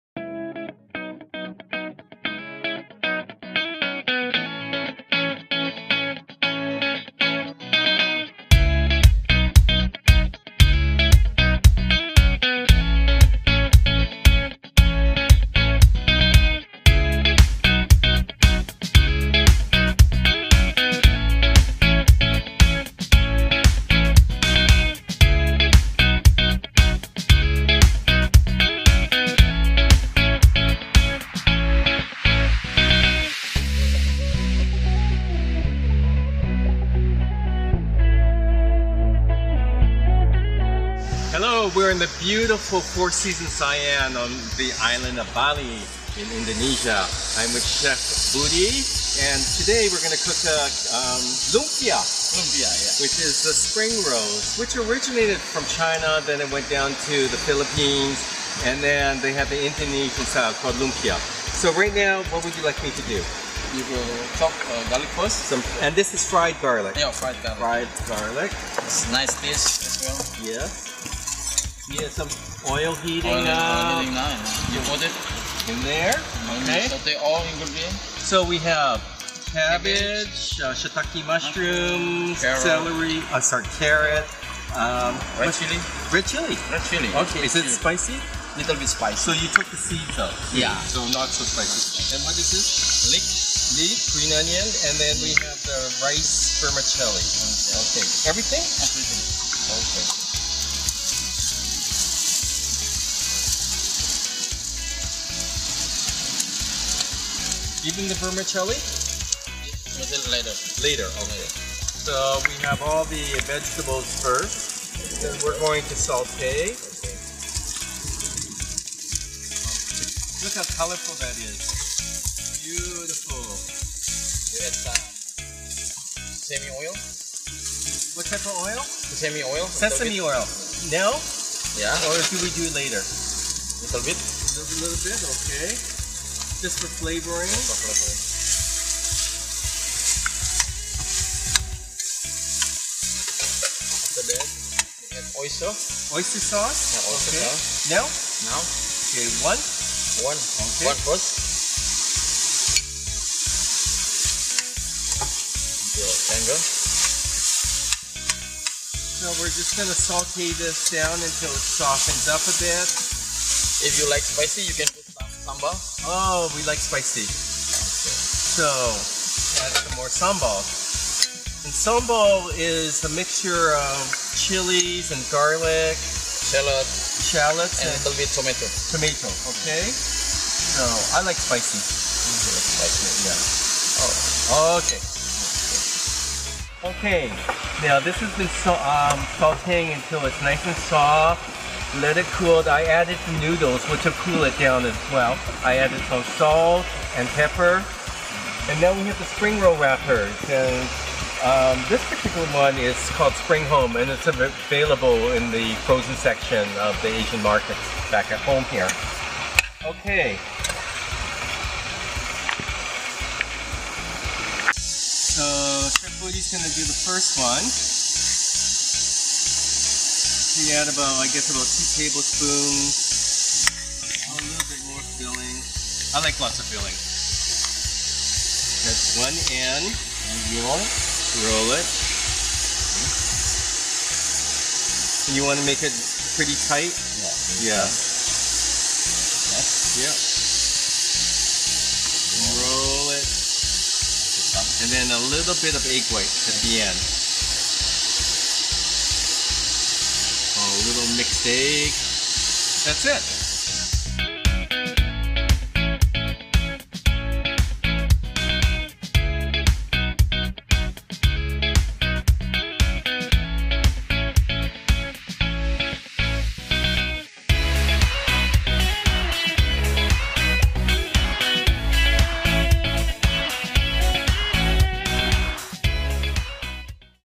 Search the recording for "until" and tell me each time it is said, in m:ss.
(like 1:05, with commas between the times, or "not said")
2:41, 3:09.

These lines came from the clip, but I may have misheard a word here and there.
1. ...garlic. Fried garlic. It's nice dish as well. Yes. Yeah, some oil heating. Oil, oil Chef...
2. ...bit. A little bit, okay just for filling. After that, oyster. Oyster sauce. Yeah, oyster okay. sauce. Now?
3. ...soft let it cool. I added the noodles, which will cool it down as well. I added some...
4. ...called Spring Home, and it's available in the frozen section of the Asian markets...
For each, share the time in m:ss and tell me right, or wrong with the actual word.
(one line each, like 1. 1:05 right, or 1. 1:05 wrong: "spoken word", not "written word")
1. 1:07 wrong: "You", not "Chef"
2. 2:14 wrong: "flavoring", not "filling"
3. 3:10 right
4. 3:23 right.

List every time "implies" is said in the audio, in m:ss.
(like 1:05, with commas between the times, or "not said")
not said.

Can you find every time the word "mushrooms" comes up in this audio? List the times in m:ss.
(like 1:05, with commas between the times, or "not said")
1:21.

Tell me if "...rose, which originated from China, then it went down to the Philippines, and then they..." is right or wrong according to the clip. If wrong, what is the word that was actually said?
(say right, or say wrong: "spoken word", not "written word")
right.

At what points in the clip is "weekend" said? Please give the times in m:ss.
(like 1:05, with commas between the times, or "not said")
not said.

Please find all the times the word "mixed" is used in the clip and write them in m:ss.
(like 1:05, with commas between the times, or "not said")
4:11.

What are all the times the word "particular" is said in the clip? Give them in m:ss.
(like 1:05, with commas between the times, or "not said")
3:22.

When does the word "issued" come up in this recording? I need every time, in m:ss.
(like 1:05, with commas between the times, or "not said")
not said.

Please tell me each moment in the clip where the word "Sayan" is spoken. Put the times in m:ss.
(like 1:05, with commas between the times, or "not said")
0:43.